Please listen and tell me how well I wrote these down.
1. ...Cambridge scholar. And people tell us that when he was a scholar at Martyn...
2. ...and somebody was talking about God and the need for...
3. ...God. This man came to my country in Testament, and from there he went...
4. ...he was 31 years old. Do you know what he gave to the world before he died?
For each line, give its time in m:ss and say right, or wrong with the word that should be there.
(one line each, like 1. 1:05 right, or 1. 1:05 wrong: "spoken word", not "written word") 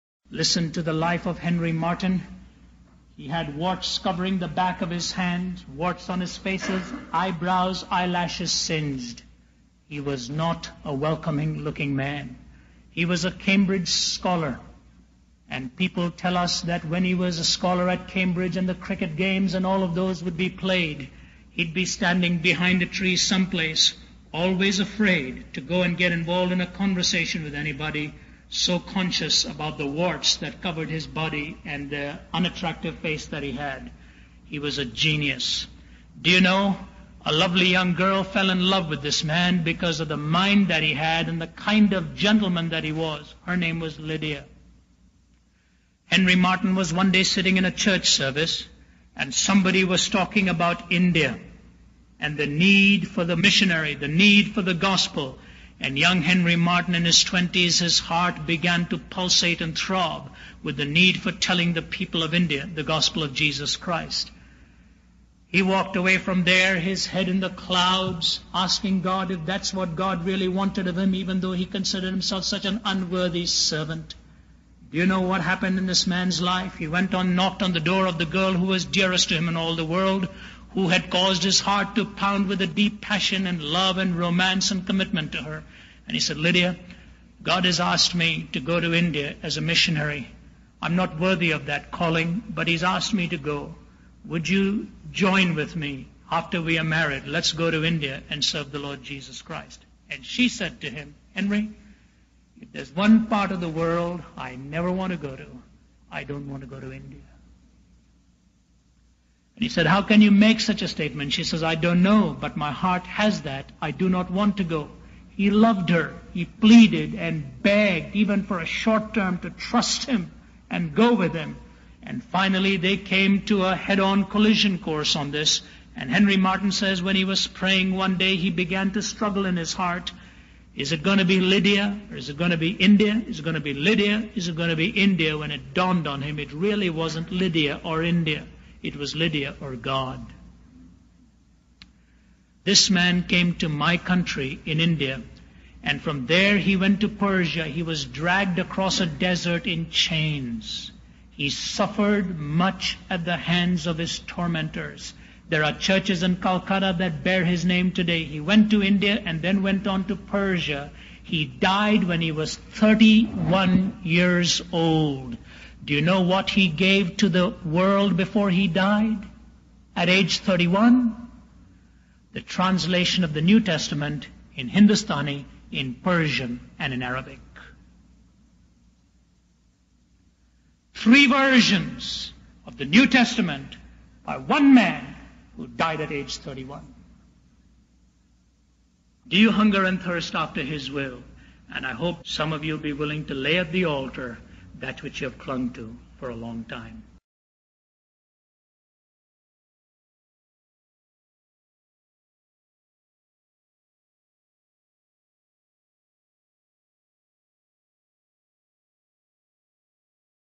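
1. 0:13 wrong: "Cambridge", not "Martyn"
2. 0:49 wrong: "India", not "God"
3. 2:19 wrong: "India", not "Testament"
4. 2:42 right.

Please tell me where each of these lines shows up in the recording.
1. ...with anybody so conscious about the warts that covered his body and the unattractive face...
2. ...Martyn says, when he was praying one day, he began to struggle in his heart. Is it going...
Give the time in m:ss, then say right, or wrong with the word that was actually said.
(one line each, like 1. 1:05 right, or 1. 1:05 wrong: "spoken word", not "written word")
1. 0:27 right
2. 2:06 right.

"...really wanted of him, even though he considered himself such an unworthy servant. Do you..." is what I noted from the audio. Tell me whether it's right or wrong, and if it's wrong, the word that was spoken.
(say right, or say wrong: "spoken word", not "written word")
right.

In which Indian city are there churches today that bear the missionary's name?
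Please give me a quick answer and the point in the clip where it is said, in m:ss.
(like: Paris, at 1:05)
Calcutta, at 2:36.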